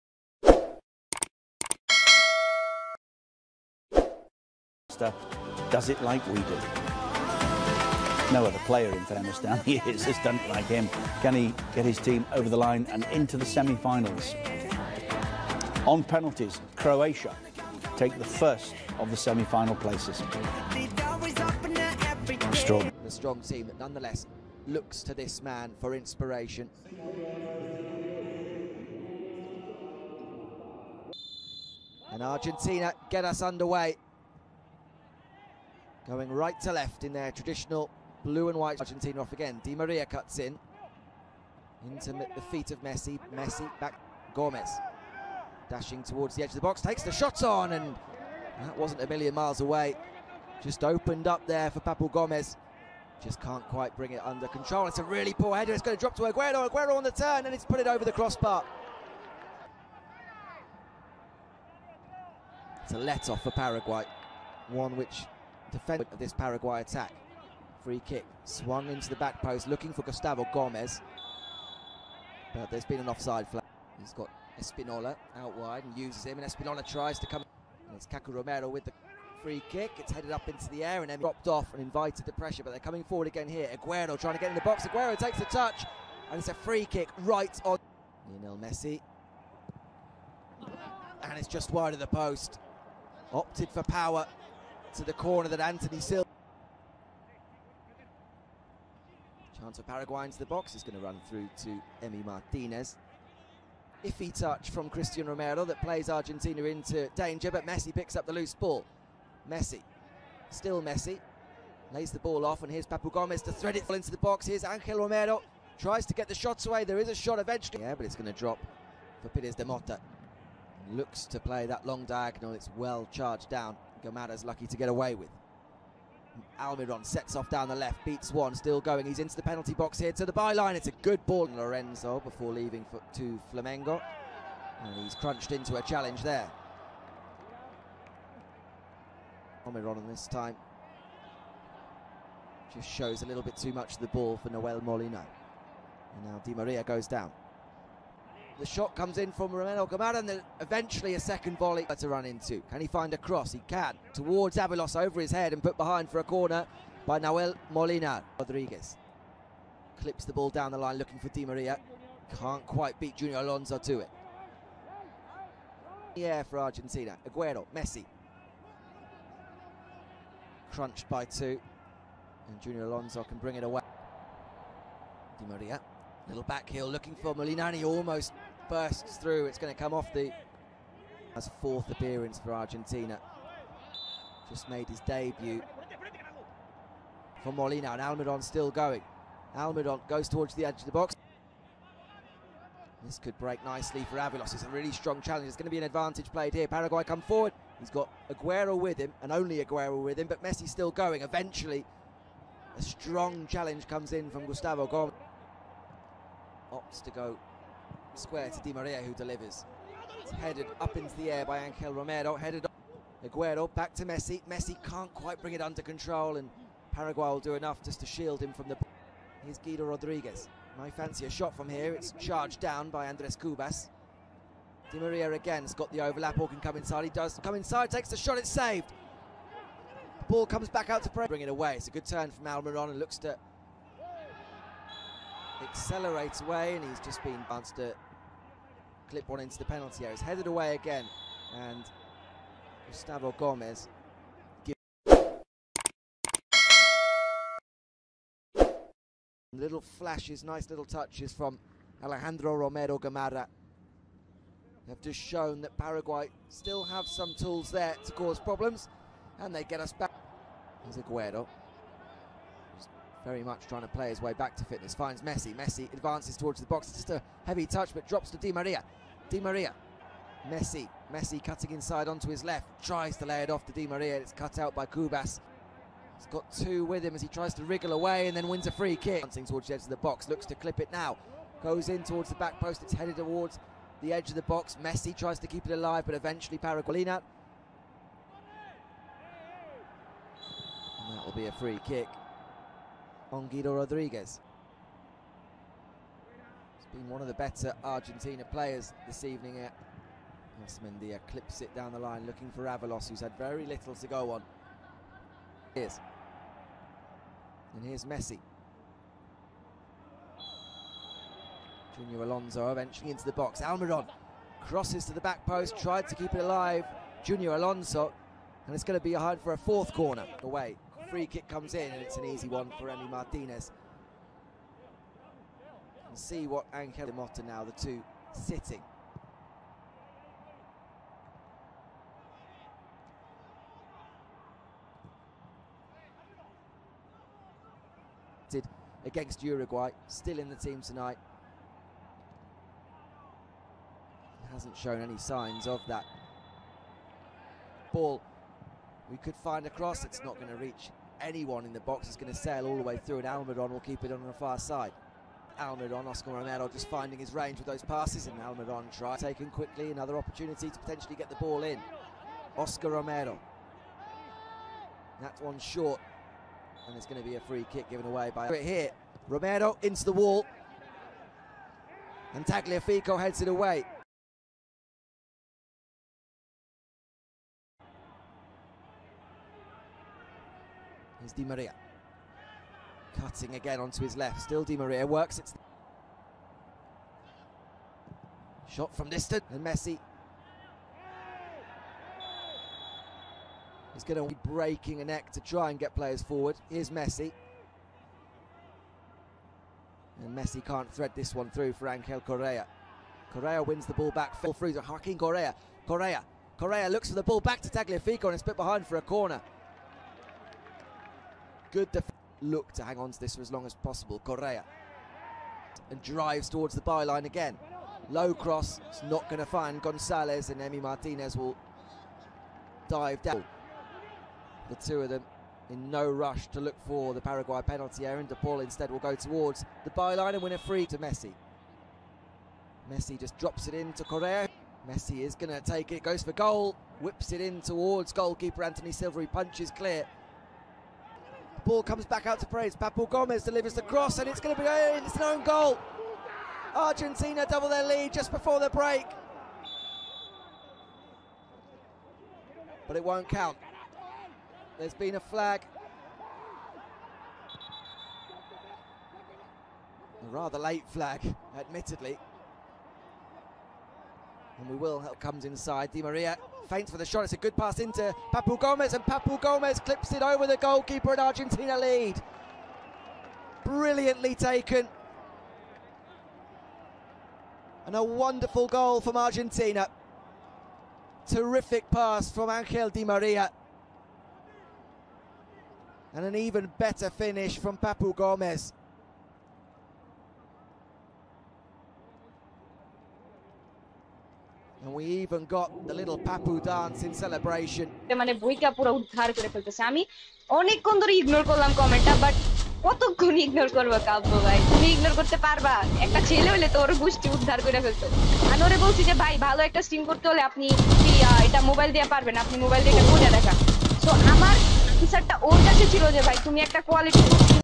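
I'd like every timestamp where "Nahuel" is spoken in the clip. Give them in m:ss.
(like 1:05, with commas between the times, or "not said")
2:24, 2:37.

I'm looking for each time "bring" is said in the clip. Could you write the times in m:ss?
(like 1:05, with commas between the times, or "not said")
0:53, 2:53, 3:35, 3:51.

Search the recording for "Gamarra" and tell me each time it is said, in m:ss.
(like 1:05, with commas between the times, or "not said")
2:04, 2:29, 4:12.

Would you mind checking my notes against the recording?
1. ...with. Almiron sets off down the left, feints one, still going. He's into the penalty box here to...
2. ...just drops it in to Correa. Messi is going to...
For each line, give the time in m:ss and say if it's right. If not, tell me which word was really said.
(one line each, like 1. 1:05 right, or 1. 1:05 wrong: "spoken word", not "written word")
1. 2:05 wrong: "beats", not "feints"
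2. 7:13 right.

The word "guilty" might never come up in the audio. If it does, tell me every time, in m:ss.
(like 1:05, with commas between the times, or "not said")
not said.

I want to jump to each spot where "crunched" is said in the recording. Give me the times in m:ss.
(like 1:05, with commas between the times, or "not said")
2:15, 2:50.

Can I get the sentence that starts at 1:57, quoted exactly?
Yeah, but it's going to drop for Pires de Mota.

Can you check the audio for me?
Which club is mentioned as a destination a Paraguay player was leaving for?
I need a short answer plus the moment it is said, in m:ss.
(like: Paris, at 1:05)
Flamengo, at 2:13.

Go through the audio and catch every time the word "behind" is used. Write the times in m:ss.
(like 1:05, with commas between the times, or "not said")
2:35, 6:48.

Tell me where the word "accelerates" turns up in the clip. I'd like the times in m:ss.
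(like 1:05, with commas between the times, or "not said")
3:55.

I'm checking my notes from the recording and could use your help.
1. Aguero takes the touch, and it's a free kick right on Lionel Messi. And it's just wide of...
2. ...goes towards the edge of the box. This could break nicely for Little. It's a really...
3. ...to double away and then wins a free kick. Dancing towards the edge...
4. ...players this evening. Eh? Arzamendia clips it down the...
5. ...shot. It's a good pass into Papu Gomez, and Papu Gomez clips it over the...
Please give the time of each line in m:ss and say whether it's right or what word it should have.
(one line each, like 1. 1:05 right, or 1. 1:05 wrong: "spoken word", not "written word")
1. 1:24 right
2. 3:10 wrong: "Avalos", not "Little"
3. 4:37 wrong: "wriggle", not "double"
4. 4:58 right
5. 7:47 right.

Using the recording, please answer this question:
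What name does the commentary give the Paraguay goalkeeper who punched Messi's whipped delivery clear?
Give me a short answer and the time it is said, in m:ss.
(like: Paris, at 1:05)
Antony Silvery, at 7:18.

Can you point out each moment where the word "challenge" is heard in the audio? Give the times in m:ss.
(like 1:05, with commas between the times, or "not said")
2:15, 3:15, 3:23.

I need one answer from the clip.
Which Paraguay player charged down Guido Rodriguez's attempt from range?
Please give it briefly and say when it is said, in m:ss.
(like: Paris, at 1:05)
Andres Cubas, at 3:43.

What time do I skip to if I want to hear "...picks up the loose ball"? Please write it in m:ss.
1:47.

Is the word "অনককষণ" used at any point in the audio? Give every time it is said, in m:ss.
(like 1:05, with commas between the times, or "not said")
8:20.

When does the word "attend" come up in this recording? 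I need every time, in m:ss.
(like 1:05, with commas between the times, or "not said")
not said.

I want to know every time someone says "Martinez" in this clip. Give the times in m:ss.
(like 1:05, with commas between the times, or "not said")
1:42, 5:23, 7:00.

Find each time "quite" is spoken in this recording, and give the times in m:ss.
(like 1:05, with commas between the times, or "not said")
0:53, 2:42, 3:35.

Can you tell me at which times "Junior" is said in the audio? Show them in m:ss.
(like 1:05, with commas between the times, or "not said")
2:43, 2:52, 5:11, 5:17.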